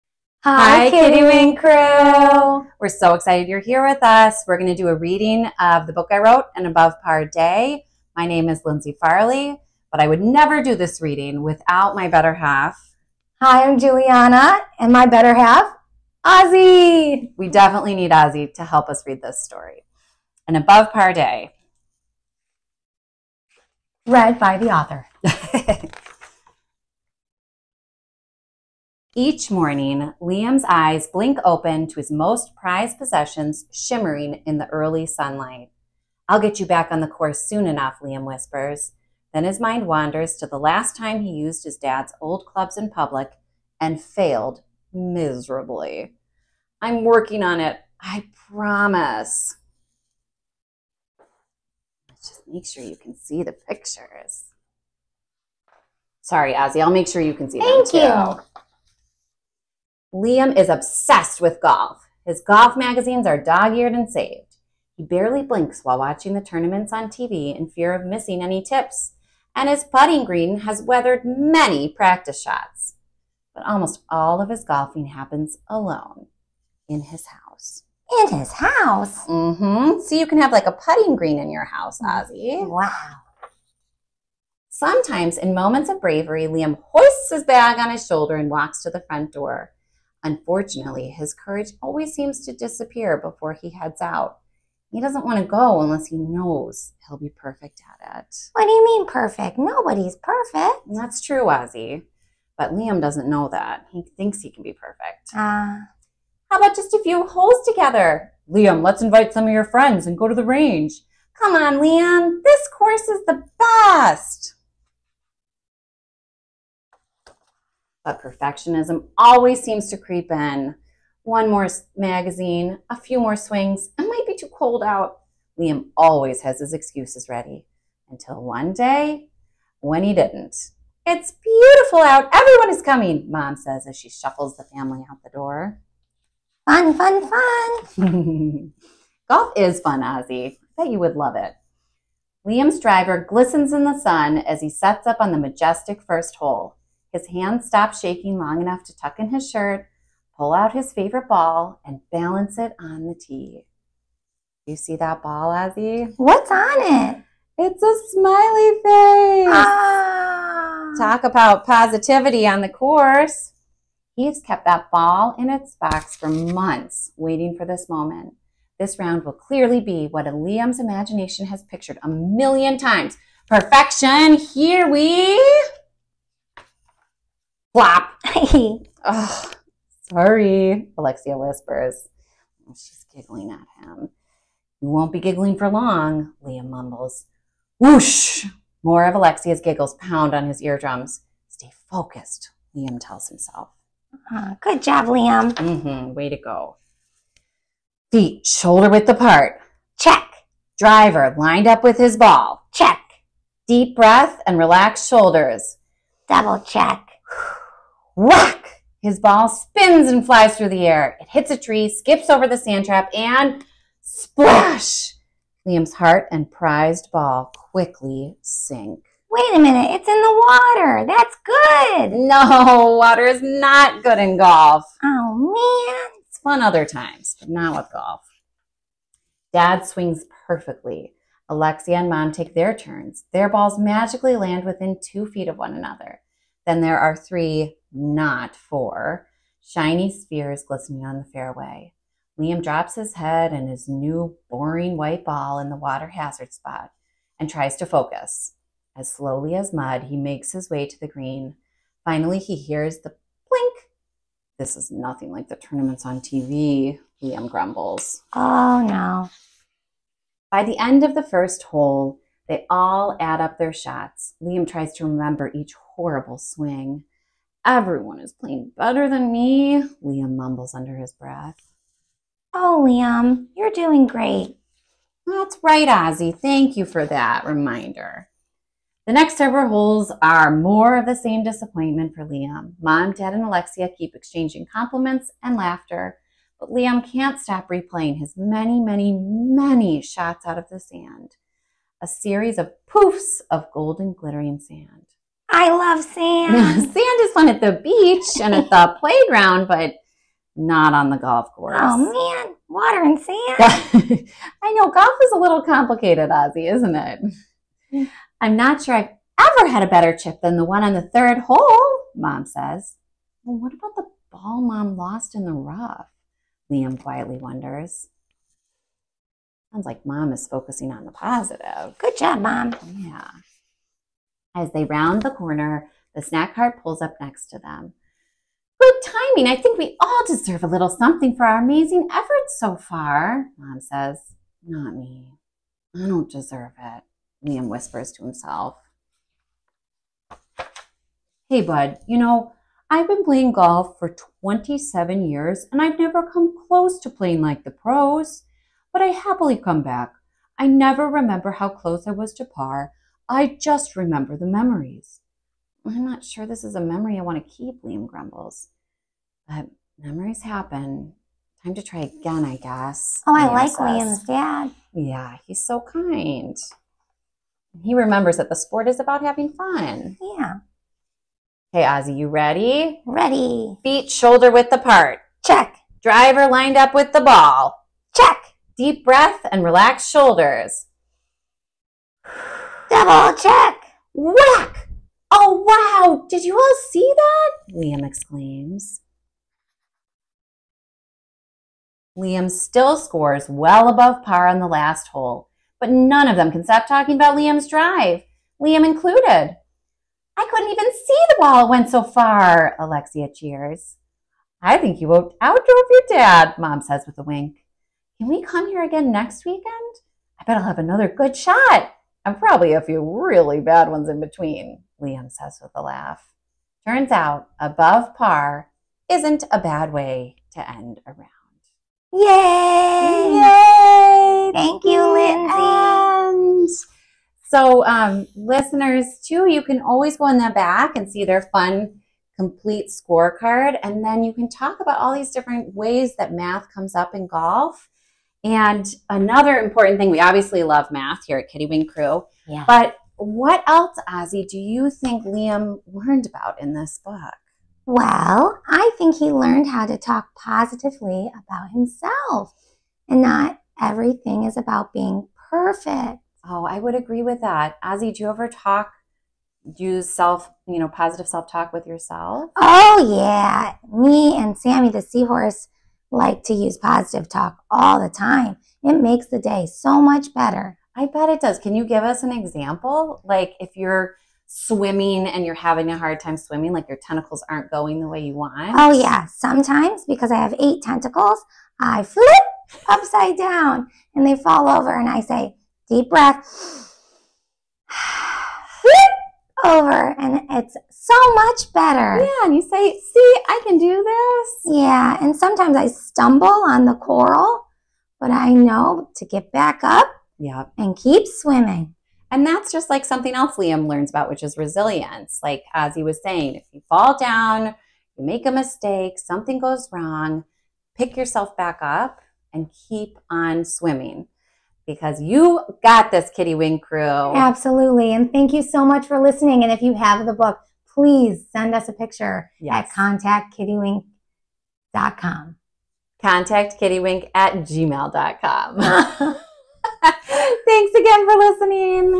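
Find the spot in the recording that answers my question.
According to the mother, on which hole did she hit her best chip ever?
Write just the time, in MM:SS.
05:11.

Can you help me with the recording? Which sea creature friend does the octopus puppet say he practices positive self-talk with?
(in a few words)
Sammy the seahorse.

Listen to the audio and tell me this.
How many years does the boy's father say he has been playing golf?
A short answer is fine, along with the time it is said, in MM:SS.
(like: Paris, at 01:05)
27, at 05:44.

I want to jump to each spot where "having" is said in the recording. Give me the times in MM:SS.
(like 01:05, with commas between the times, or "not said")
06:09, 07:55.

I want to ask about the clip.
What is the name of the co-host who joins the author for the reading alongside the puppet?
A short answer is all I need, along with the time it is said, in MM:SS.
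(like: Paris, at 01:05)
Juliana, at 00:13.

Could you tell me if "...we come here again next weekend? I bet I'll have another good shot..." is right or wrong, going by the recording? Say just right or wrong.
right.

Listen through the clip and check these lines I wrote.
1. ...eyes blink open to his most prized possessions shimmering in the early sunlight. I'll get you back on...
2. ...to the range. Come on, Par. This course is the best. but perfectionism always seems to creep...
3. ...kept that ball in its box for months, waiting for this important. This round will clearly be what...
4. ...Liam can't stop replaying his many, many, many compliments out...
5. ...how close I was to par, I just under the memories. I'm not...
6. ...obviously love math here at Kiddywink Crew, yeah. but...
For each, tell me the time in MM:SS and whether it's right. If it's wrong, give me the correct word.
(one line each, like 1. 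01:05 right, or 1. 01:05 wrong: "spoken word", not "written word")
1. 00:30 right
2. 01:50 wrong: "Liam", not "Par"
3. 02:44 wrong: "moment", not "important"
4. 04:46 wrong: "shots", not "compliments"
5. 05:51 wrong: "remember", not "under"
6. 07:20 right.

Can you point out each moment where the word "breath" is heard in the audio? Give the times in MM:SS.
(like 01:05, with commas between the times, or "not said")
03:23, 04:31, 06:19, 08:06.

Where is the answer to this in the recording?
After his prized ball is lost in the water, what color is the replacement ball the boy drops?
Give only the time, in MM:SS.
04:04.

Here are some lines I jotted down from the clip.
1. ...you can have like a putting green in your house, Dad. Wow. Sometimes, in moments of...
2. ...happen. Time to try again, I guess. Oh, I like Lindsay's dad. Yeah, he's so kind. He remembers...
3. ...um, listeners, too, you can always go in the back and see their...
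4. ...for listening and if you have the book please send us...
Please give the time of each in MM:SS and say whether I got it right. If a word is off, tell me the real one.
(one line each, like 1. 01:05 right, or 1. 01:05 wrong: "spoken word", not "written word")
1. 01:20 wrong: "Ozzie", not "Dad"
2. 06:00 wrong: "Liam", not "Lindsay"
3. 07:07 right
4. 08:39 right.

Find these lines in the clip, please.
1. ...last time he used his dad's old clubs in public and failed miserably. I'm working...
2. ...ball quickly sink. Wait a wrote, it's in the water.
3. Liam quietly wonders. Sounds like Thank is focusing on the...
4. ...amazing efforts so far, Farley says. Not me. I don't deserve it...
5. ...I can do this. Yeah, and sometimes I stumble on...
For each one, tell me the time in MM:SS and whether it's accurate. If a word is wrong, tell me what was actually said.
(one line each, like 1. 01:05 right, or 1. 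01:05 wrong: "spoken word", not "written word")
1. 00:40 right
2. 03:37 wrong: "minute", not "wrote"
3. 05:16 wrong: "Mom", not "Thank"
4. 05:31 wrong: "Mom", not "Farley"
5. 08:13 right.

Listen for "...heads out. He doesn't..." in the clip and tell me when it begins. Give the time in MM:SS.
01:33.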